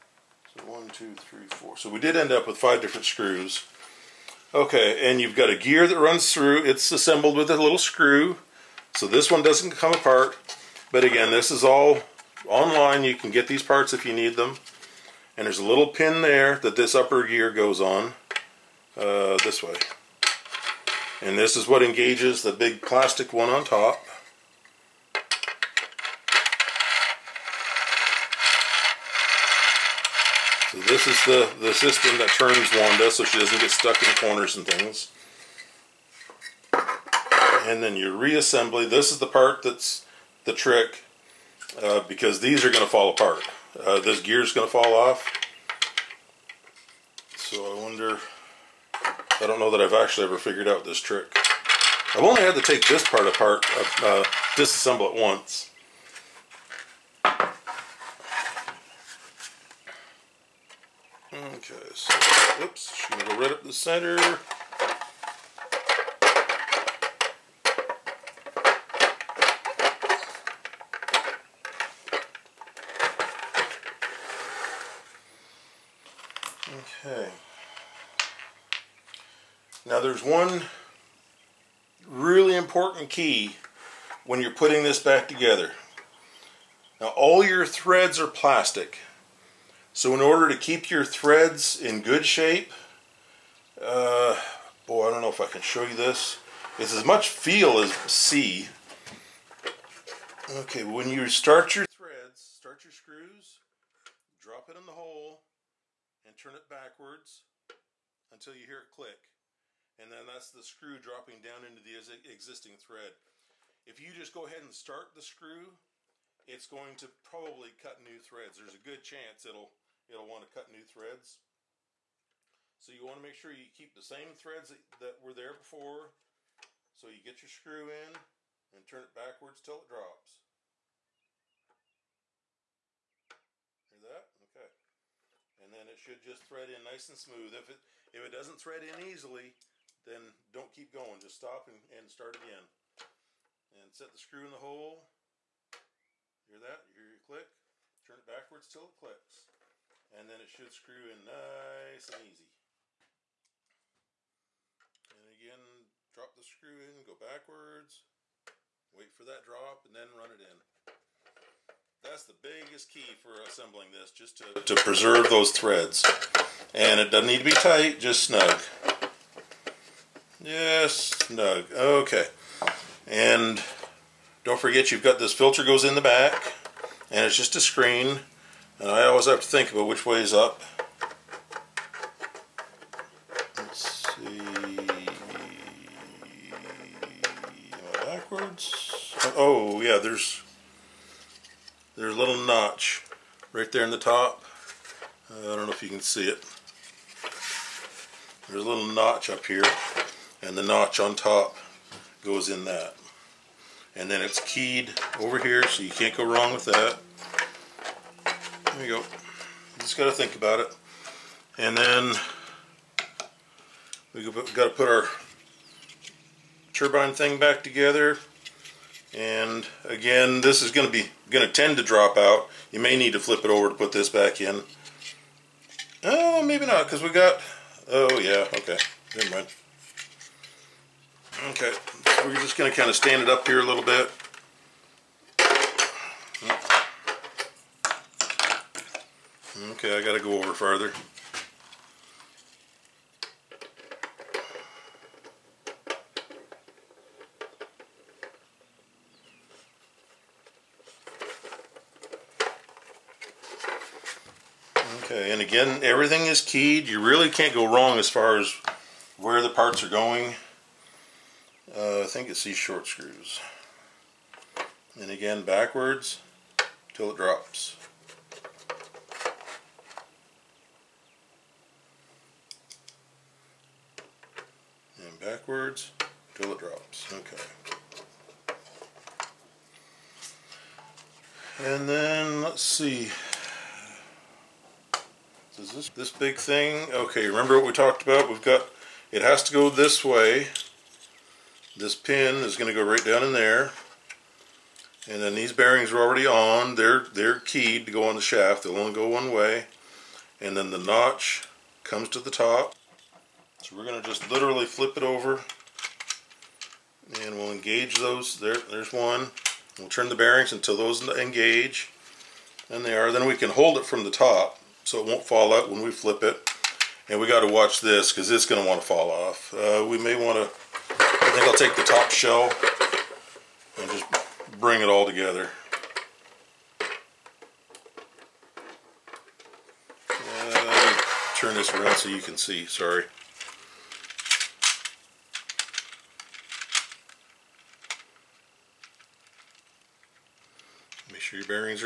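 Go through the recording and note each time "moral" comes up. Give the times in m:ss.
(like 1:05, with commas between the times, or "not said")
not said.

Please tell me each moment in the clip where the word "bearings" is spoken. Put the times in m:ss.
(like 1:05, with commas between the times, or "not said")
4:55, 5:10.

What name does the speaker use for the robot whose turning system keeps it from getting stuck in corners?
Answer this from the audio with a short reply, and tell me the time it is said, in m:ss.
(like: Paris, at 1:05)
Wanda, at 0:32.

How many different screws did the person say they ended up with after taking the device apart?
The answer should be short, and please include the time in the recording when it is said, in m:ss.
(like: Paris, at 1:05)
5, at 0:02.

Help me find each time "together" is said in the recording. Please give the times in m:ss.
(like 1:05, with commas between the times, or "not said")
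1:25, 3:37, 5:25.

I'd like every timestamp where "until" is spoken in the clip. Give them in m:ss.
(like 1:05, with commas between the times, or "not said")
1:48, 5:10.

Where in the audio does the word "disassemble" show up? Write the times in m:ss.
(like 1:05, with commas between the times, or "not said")
0:54.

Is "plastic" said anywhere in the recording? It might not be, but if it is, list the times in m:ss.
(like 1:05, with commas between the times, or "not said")
0:22, 1:28.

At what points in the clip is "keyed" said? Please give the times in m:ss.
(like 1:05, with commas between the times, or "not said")
3:24, 4:16, 4:57.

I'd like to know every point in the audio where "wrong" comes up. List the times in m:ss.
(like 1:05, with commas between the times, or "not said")
3:26, 4:17.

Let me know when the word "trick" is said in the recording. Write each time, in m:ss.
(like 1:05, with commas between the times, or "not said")
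0:40, 0:50.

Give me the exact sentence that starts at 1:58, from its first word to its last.
There's a good chance it'll it'll want to cut new threads.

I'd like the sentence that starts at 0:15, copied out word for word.
And there's a little pin there that this upper gear goes on uh, this way.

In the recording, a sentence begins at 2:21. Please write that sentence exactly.
Just stop and, and start again.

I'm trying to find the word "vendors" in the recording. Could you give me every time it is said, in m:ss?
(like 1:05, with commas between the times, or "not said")
not said.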